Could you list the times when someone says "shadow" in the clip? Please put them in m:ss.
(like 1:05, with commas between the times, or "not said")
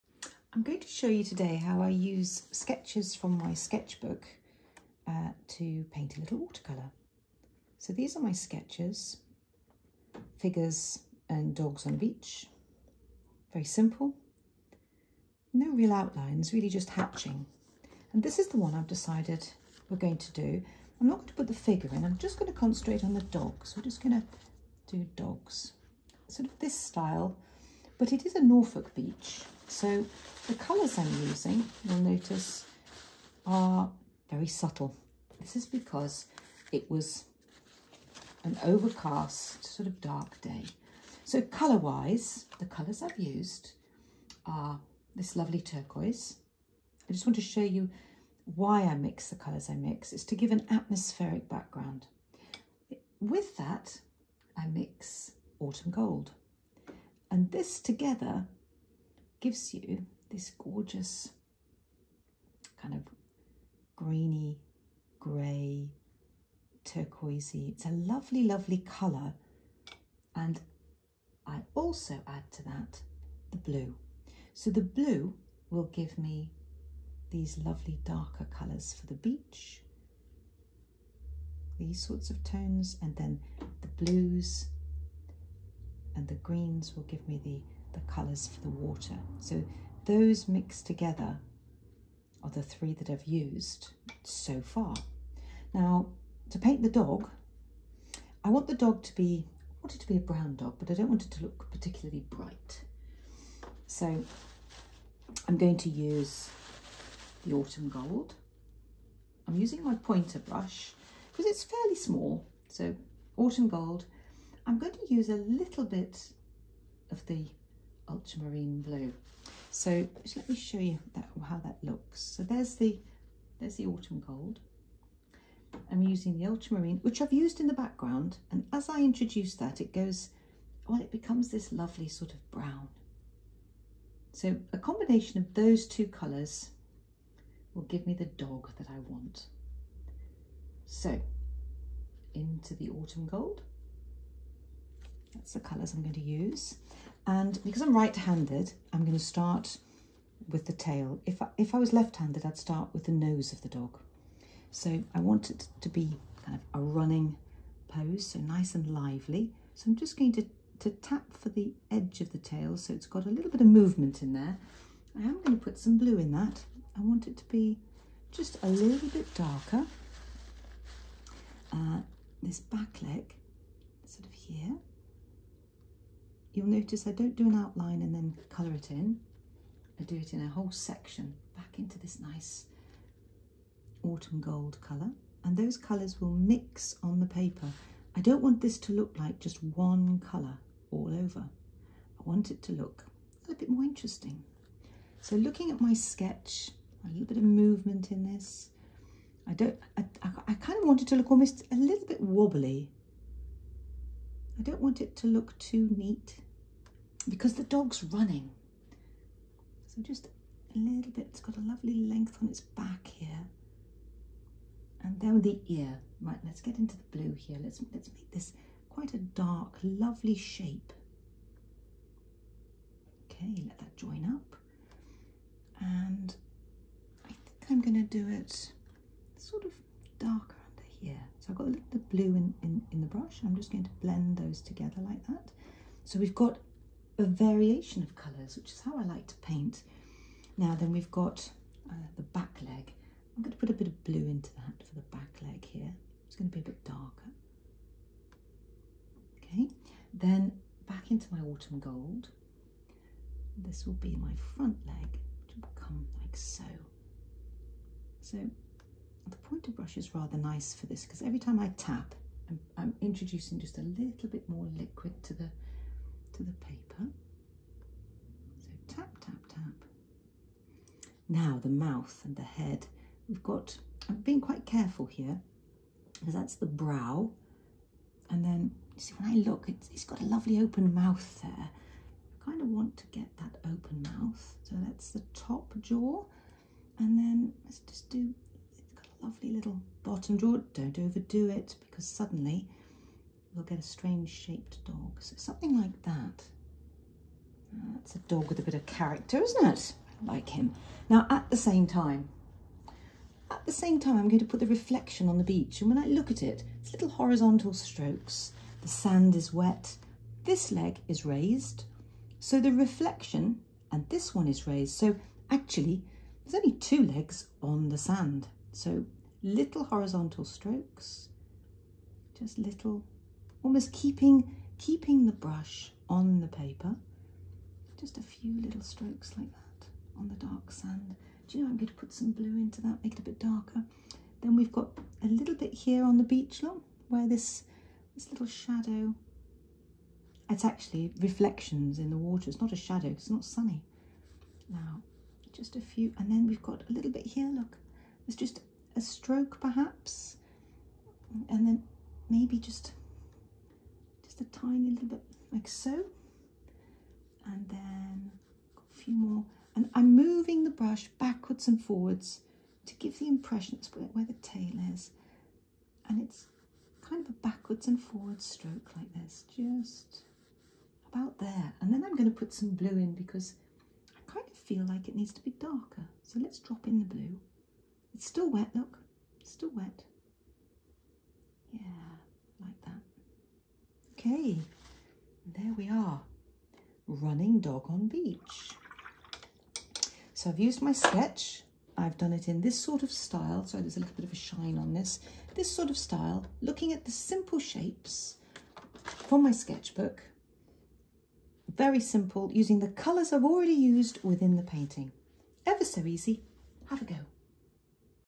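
5:38, 5:42.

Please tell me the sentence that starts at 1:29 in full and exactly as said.
So those mixed together are the three that I've used so far.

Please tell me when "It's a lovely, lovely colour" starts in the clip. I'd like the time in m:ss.
1:07.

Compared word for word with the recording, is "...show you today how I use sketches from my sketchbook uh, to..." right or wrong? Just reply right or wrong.
right.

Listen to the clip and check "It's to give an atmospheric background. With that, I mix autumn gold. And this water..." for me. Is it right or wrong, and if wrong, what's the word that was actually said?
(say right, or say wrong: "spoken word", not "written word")
wrong: "together", not "water".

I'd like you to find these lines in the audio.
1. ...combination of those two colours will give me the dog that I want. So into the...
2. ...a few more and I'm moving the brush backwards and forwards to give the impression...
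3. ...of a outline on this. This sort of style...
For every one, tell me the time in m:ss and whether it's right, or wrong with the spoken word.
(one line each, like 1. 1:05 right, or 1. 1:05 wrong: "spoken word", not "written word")
1. 2:14 right
2. 5:58 right
3. 6:34 wrong: "shine", not "outline".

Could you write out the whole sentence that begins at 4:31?
Now the mouth and the head.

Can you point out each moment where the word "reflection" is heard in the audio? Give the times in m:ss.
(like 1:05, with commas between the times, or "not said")
5:04, 5:12, 5:41.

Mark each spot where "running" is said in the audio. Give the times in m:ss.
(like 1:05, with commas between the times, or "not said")
2:36, 3:28, 6:27.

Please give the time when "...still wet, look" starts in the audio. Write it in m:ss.
6:18.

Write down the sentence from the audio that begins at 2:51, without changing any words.
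Uh, this back leg, sort of here, you'll notice I don't do an outline and then colour it in.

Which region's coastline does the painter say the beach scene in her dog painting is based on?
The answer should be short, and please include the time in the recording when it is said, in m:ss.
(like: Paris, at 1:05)
Norfolk, at 0:28.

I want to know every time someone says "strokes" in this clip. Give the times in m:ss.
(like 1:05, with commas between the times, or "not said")
5:07, 5:20, 5:28, 5:49, 6:08.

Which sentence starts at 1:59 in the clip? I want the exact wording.
So just let me show you that, how that looks.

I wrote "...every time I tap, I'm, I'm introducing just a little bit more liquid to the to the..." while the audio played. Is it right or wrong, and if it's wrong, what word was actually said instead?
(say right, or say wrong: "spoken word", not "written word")
right.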